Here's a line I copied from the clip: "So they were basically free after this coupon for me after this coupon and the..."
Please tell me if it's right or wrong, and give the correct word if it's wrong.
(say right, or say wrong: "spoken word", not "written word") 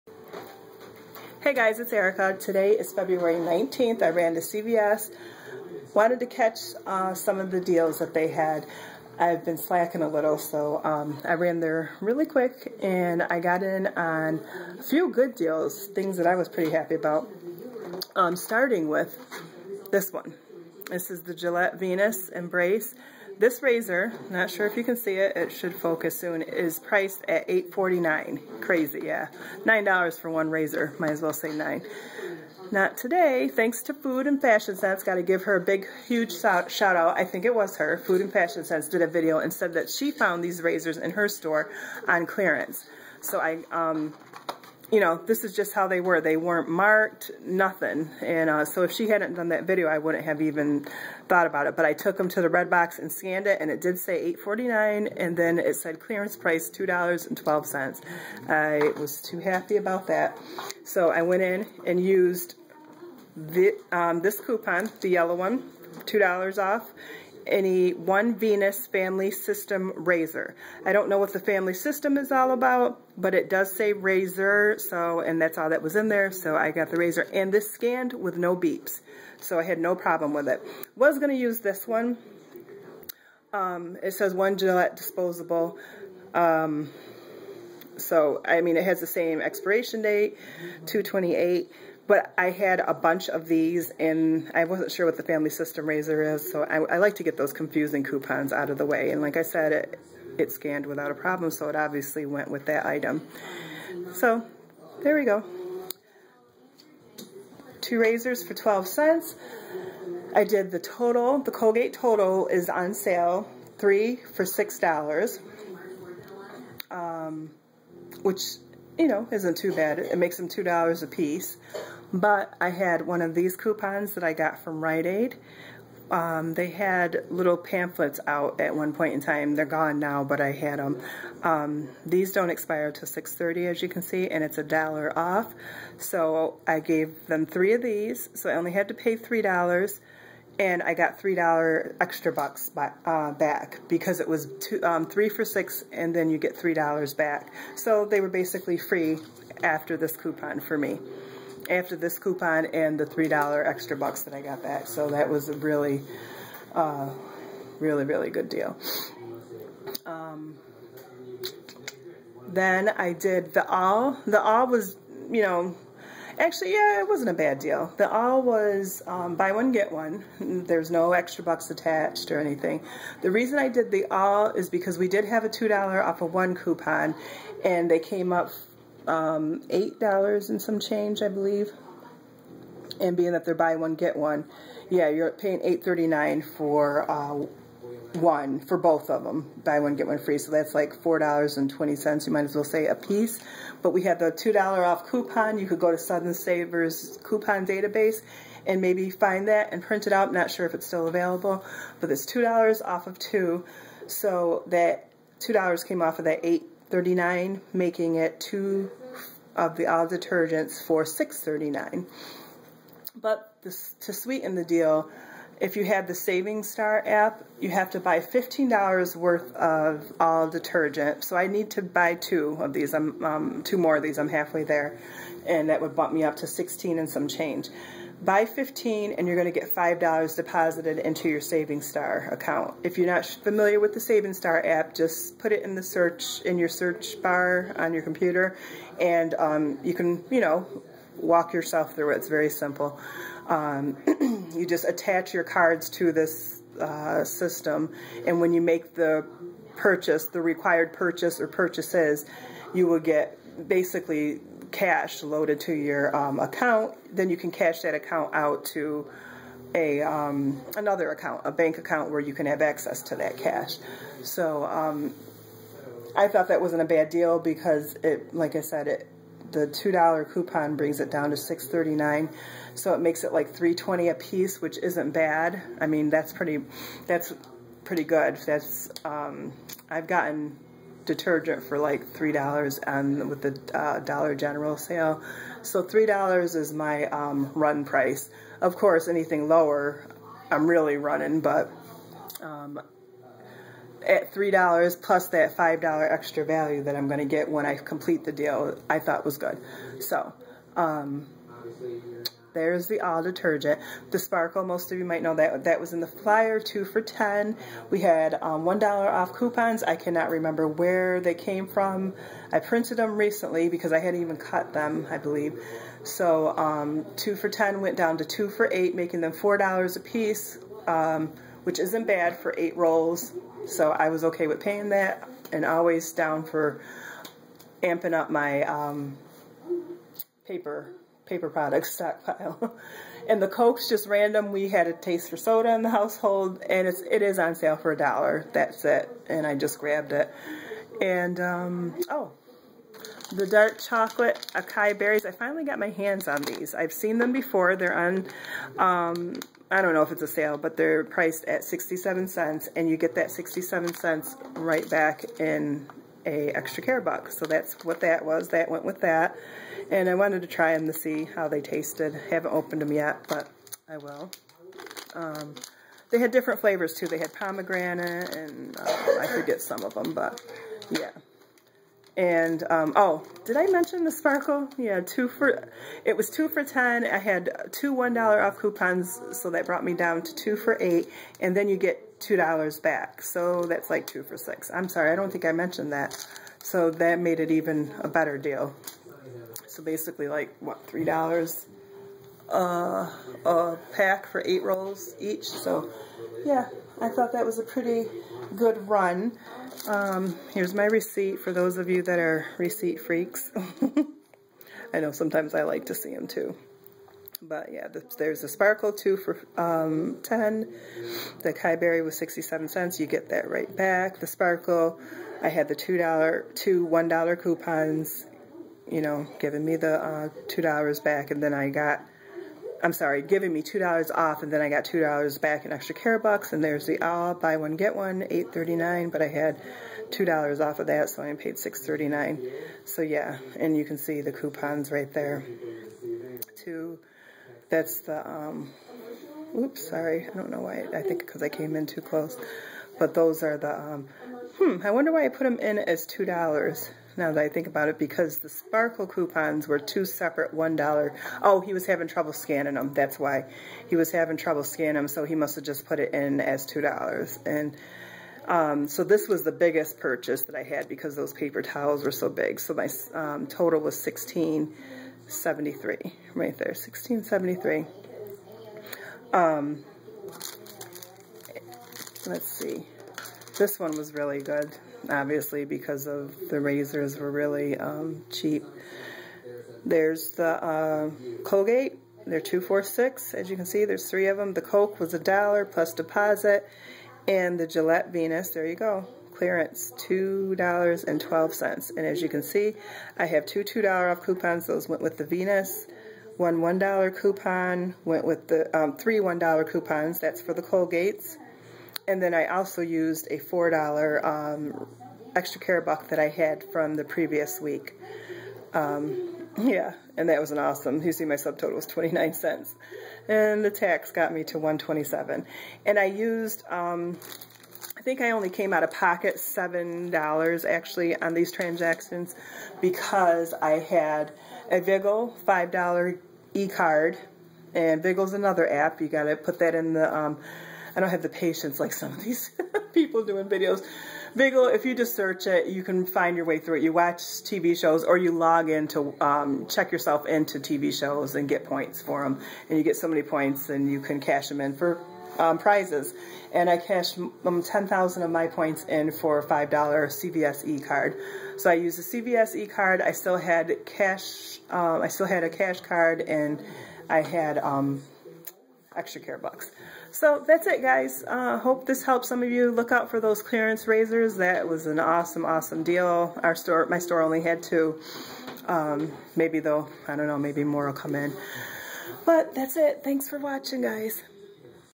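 right.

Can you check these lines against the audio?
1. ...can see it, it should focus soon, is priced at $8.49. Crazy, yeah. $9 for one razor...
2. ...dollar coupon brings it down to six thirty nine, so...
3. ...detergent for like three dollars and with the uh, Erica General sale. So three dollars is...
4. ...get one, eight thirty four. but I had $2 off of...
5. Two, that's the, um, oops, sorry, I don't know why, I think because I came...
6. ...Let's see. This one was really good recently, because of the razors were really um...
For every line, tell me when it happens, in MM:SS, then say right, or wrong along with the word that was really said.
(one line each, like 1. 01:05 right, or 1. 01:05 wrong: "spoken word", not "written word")
1. 00:24 right
2. 04:29 right
3. 04:41 wrong: "Dollar", not "Erica"
4. 07:07 wrong: "nine", not "four"
5. 07:16 right
6. 07:52 wrong: "obviously", not "recently".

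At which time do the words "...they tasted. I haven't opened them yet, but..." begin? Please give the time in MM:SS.
06:01.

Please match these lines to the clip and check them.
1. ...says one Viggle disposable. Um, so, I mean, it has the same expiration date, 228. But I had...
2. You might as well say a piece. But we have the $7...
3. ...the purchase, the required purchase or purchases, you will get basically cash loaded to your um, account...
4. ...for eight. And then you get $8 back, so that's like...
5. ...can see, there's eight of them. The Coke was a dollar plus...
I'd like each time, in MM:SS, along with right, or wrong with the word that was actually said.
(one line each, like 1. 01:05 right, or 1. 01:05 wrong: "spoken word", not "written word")
1. 01:24 wrong: "Gillette", not "Viggle"
2. 03:12 wrong: "2", not "7"
3. 04:08 right
4. 06:20 wrong: "2", not "8"
5. 08:03 wrong: "three", not "eight".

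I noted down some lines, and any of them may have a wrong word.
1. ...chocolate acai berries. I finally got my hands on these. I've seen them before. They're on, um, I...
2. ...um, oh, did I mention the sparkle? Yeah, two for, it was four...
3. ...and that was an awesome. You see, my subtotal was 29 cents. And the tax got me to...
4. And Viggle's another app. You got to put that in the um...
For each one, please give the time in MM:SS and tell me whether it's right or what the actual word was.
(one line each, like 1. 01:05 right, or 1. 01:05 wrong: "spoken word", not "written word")
1. 05:43 right
2. 06:12 wrong: "two", not "four"
3. 08:30 right
4. 08:47 right.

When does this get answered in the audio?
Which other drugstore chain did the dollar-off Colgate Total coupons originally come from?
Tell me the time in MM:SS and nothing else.
02:04.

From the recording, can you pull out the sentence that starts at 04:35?
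I mean that's pretty, that's pretty good.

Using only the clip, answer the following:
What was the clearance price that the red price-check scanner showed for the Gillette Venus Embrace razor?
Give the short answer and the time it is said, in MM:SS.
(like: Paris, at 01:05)
$2.12, at 00:56.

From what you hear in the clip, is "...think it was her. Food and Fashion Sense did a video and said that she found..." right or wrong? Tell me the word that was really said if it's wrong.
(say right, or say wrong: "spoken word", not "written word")
right.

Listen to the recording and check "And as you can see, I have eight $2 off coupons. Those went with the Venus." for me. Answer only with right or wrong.
wrong.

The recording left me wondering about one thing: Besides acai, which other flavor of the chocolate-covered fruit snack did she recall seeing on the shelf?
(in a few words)
pomegranate.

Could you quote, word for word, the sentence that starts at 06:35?
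So yeah, I thought that was a pretty good run.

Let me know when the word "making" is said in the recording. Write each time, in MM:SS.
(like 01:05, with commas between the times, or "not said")
03:27, 05:18.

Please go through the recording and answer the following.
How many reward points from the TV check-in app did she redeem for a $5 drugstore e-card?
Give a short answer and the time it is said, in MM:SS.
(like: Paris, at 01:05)
10,000, at 09:07.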